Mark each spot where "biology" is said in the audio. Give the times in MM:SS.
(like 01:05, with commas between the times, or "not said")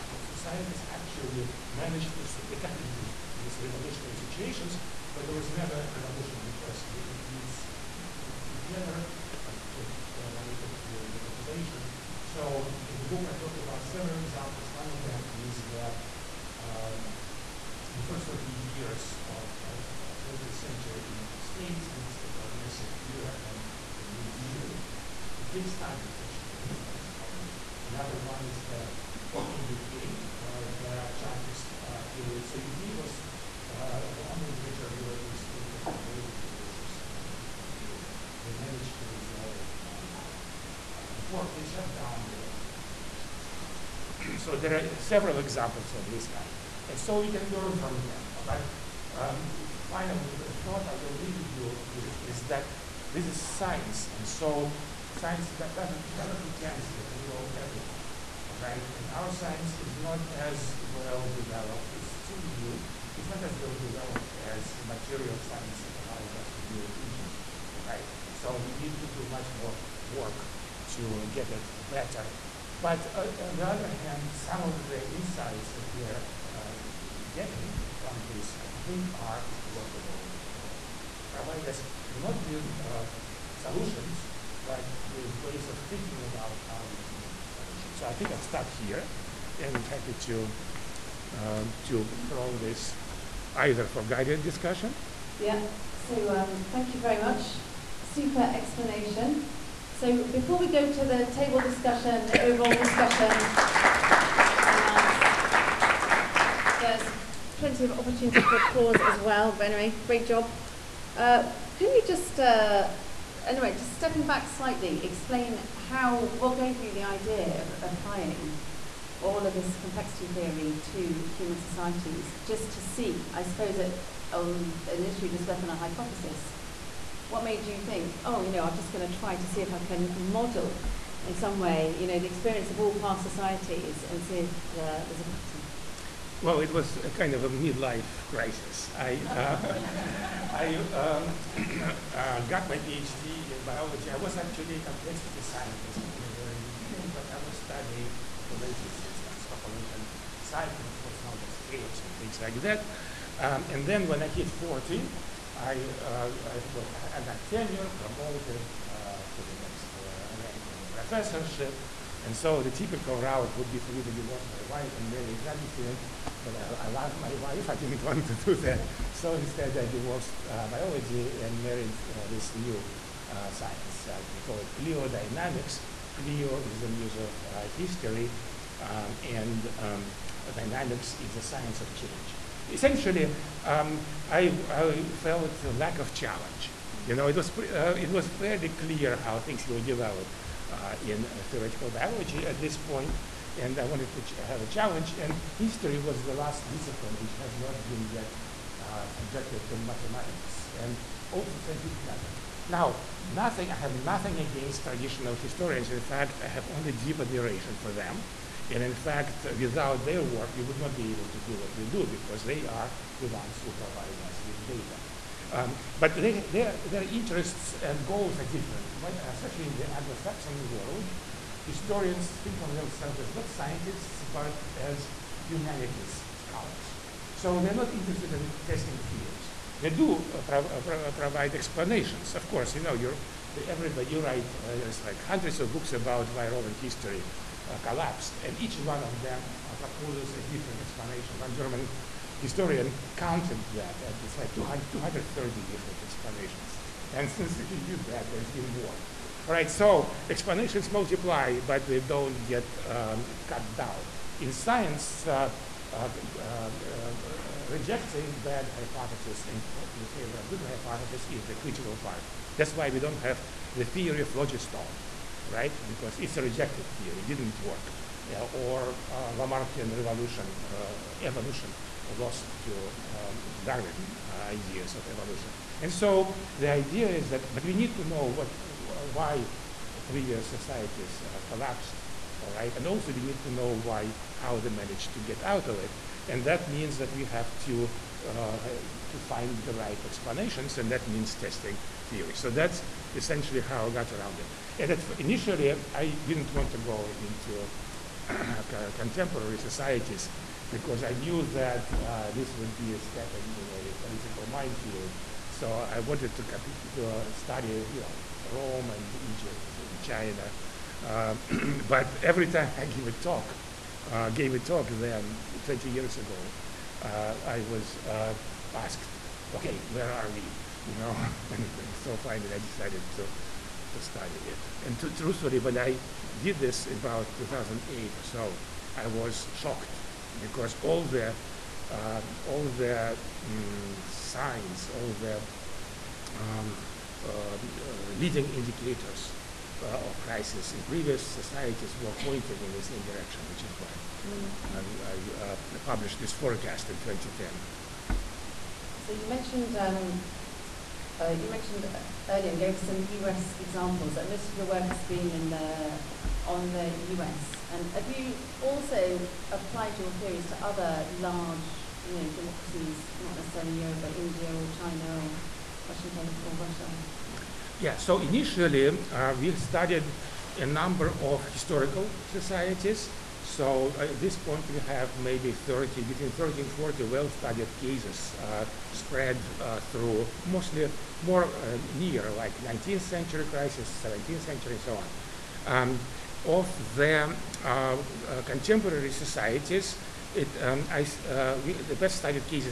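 02:23, 02:50, 03:11.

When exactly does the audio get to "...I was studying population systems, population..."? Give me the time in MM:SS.
02:27.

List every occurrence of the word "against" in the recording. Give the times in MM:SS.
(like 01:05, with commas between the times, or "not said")
03:24.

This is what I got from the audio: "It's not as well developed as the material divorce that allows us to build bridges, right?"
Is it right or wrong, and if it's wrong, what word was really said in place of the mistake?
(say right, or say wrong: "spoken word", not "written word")
wrong: "science", not "divorce".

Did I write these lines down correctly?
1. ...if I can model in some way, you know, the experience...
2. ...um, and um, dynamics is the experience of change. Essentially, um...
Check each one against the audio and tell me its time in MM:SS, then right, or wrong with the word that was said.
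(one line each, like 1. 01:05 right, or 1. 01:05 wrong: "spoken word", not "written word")
1. 02:09 right
2. 02:58 wrong: "science", not "experience".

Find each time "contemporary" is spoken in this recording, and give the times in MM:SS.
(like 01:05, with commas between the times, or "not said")
04:58, 06:28.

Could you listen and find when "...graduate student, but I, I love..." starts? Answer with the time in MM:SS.
02:45.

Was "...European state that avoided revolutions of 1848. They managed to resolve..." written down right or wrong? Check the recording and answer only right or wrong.
right.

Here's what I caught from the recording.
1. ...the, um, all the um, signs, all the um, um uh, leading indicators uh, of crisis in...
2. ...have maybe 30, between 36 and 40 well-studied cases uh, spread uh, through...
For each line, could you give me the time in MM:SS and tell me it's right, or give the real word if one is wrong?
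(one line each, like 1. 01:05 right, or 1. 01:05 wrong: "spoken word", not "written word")
1. 05:31 right
2. 06:14 wrong: "30", not "36".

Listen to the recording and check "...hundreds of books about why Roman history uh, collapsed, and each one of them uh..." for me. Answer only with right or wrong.
right.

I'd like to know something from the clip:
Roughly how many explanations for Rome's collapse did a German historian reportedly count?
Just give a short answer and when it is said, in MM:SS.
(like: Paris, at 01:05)
230, at 04:04.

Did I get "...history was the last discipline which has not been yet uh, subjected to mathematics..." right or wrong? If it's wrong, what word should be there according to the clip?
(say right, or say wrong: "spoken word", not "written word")
right.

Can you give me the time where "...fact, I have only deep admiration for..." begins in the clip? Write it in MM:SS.
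03:25.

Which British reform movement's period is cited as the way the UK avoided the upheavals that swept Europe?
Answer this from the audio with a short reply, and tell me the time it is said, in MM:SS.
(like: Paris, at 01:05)
Chartist, at 00:31.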